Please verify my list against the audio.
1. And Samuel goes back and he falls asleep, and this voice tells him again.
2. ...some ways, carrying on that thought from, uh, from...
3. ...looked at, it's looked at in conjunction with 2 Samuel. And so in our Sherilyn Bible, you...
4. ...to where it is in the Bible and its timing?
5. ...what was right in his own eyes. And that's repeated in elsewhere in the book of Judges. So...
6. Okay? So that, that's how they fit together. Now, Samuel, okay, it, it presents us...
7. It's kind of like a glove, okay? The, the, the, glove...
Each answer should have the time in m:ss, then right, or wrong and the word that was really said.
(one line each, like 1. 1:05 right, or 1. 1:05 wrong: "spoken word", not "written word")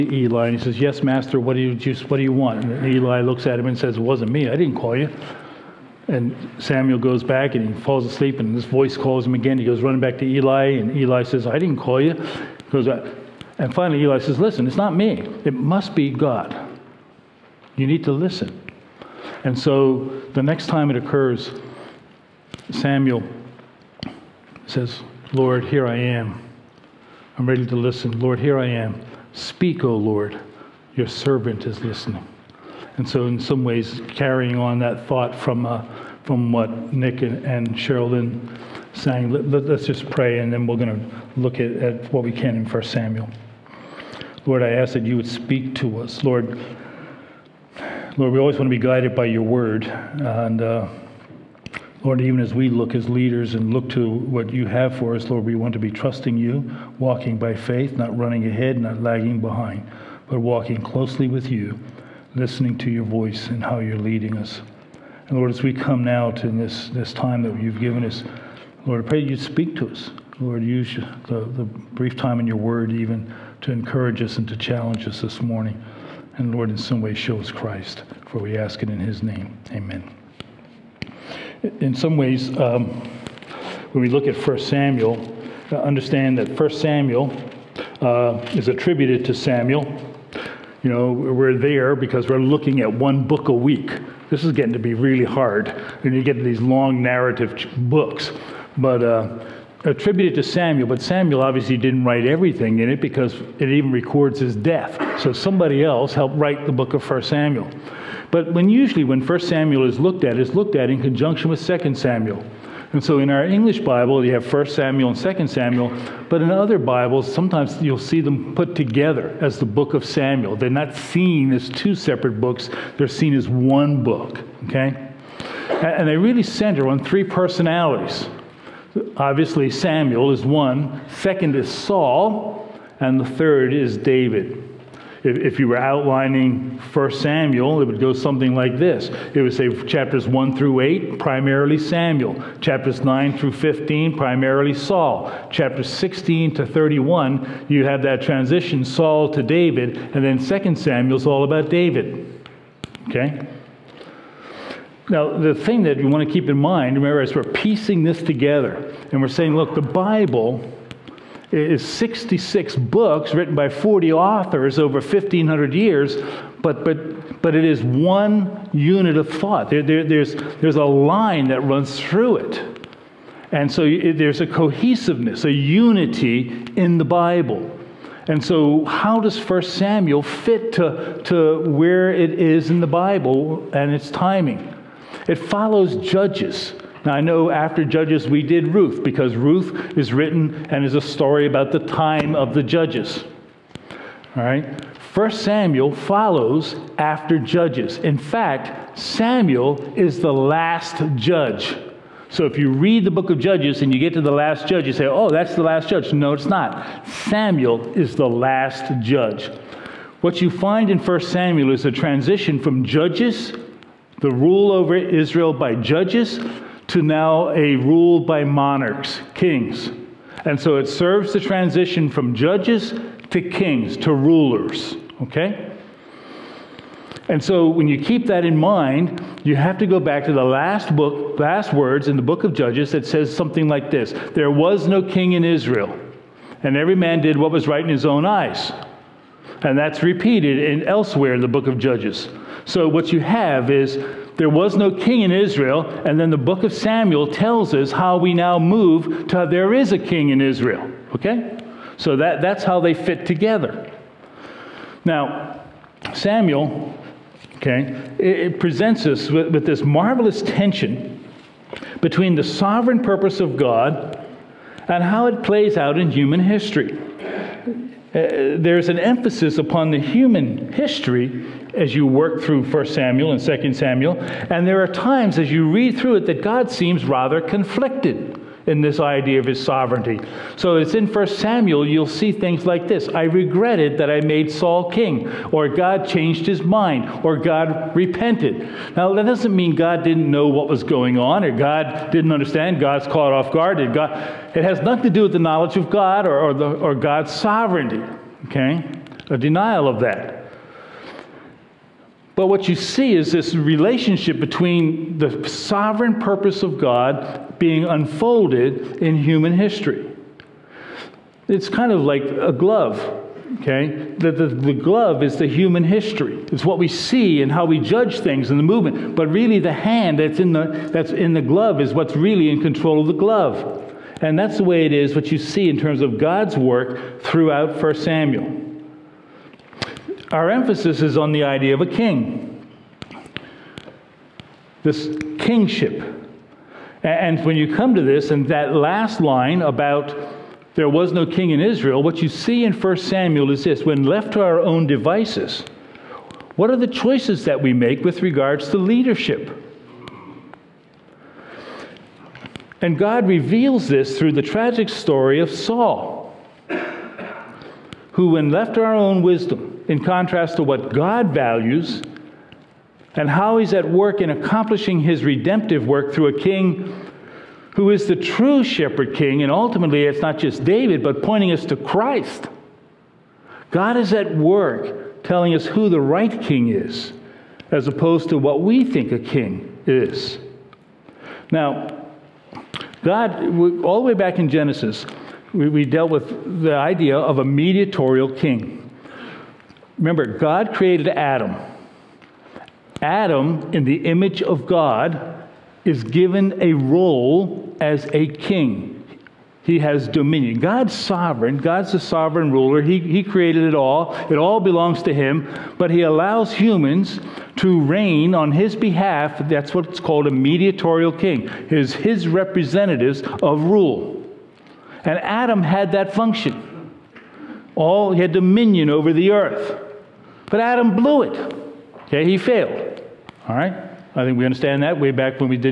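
1. 0:06 wrong: "calls", not "tells"
2. 0:33 right
3. 1:49 wrong: "English", not "Sherilyn"
4. 3:01 right
5. 3:57 right
6. 4:11 right
7. 5:11 right.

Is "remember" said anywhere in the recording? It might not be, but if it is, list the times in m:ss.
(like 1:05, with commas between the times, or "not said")
2:36, 6:29.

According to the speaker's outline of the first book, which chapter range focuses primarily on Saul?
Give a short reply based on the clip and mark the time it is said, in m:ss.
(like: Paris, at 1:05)
9 through 15, at 2:23.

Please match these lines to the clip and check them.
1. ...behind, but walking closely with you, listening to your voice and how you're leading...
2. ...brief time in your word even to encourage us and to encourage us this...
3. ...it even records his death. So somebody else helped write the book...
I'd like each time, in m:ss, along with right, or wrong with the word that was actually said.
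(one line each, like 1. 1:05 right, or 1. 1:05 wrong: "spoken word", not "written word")
1. 0:59 right
2. 1:11 wrong: "challenge", not "encourage"
3. 1:43 right.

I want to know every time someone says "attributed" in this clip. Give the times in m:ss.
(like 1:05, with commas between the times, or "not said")
1:28, 1:39.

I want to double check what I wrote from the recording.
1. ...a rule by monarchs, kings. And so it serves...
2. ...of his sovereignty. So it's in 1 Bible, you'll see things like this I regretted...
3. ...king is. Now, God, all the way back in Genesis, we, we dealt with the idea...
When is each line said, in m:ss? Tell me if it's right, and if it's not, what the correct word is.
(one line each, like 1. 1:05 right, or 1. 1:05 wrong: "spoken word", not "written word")
1. 3:37 right
2. 4:39 wrong: "Samuel", not "Bible"
3. 6:19 right.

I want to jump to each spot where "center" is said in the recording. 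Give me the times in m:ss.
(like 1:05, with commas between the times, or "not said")
2:06.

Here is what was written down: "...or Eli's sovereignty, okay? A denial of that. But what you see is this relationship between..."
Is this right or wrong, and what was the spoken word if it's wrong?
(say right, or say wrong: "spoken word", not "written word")
wrong: "God", not "Eli".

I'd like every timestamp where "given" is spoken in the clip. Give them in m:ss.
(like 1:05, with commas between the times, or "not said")
1:07, 6:36.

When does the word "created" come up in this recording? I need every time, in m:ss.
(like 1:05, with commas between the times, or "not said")
6:30, 6:43.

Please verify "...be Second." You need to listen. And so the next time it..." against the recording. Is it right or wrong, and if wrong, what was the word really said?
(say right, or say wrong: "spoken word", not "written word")
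wrong: "God", not "Second".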